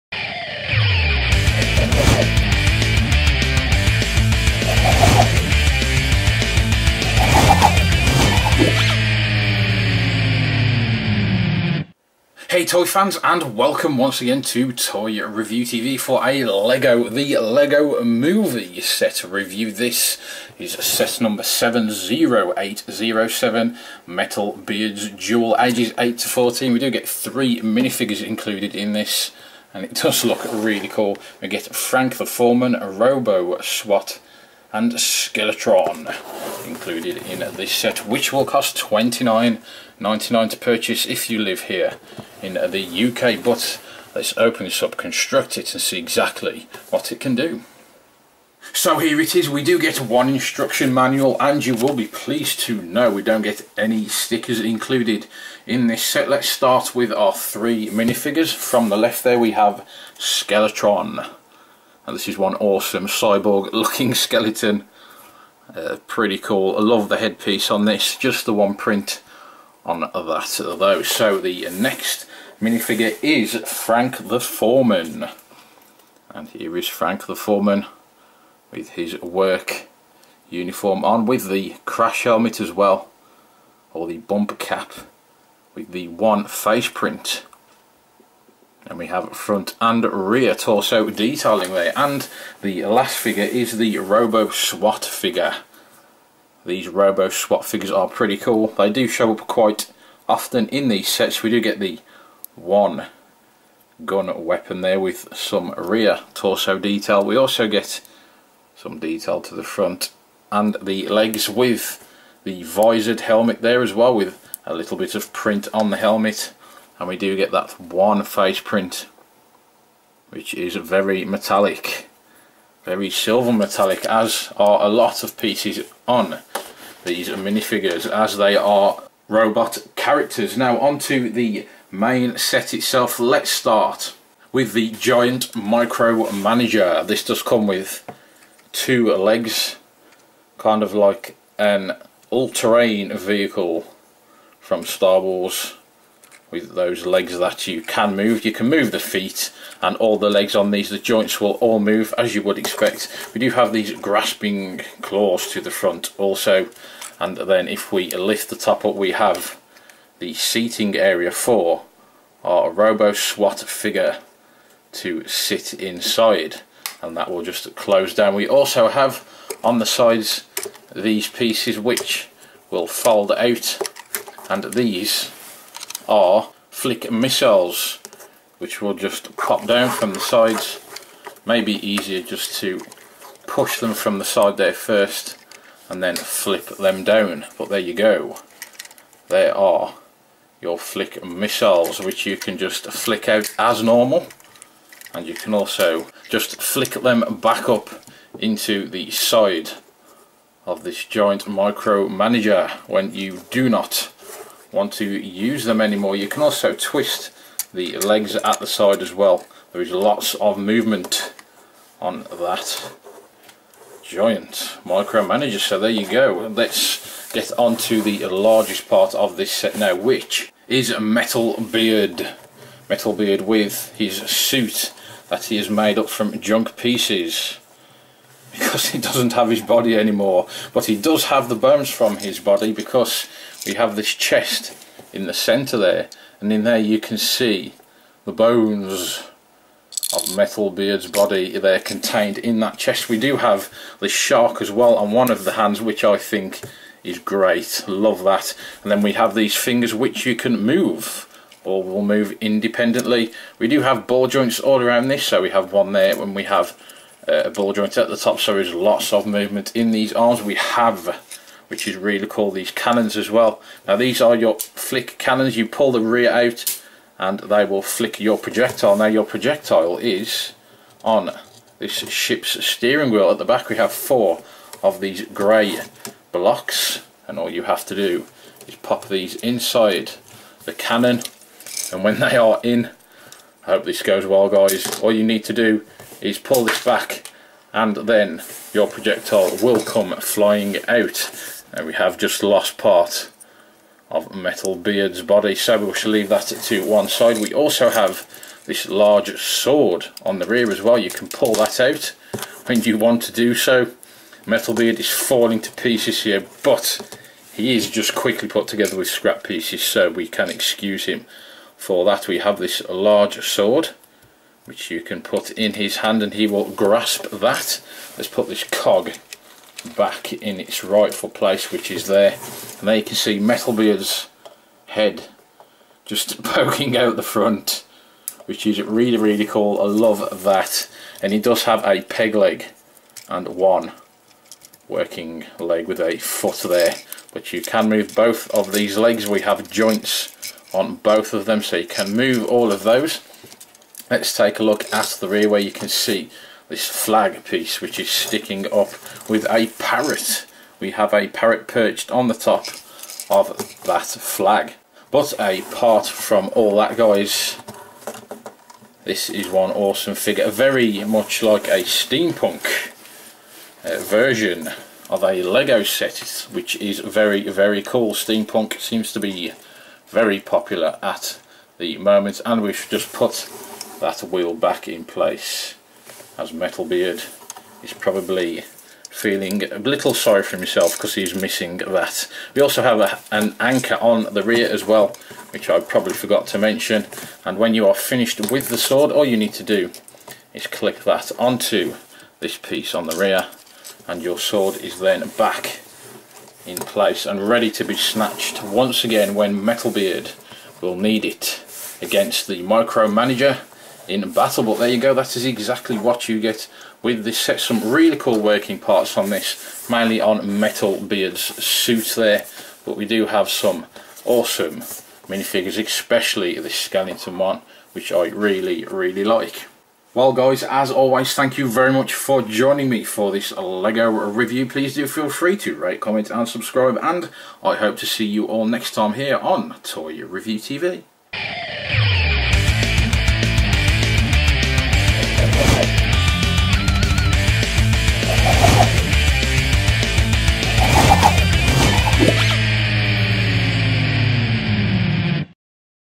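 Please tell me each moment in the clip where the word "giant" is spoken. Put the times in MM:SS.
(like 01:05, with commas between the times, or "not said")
02:14, 03:21, 03:34.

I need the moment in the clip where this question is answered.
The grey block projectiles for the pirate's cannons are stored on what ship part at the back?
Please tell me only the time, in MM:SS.
04:32.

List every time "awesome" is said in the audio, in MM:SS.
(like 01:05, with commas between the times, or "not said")
01:02, 05:59, 06:54.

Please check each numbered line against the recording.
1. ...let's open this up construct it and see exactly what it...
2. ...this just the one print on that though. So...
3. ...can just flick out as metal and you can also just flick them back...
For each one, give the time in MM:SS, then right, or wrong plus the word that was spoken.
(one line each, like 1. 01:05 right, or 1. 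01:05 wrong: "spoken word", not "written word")
1. 00:44 right
2. 01:07 right
3. 03:12 wrong: "normal", not "metal".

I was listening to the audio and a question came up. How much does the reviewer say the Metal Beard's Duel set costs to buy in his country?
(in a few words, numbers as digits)
29.99.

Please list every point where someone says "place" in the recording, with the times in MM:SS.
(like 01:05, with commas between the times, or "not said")
05:21, 06:15, 06:36.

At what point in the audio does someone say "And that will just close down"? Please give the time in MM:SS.
02:47.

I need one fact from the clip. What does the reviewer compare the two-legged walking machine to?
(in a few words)
all-terrain vehicle.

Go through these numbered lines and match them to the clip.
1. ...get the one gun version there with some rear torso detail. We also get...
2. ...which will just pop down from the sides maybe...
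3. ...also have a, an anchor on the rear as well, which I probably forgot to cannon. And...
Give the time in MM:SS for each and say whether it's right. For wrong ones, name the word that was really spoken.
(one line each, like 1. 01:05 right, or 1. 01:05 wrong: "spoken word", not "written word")
1. 01:41 wrong: "weapon", not "version"
2. 02:58 right
3. 06:22 wrong: "mention", not "cannon".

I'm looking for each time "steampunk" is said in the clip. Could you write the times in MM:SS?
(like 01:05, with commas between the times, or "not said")
06:01, 06:08.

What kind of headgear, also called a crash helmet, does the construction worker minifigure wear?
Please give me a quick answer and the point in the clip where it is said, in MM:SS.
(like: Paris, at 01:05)
bumper cap, at 01:24.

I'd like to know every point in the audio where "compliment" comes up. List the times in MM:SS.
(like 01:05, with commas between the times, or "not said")
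not said.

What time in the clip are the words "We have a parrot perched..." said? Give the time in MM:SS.
05:50.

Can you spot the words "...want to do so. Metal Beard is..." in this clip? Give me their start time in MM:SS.
05:02.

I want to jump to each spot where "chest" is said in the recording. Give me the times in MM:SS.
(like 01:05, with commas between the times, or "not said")
03:54, 04:02.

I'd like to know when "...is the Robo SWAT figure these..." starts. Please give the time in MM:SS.
01:33.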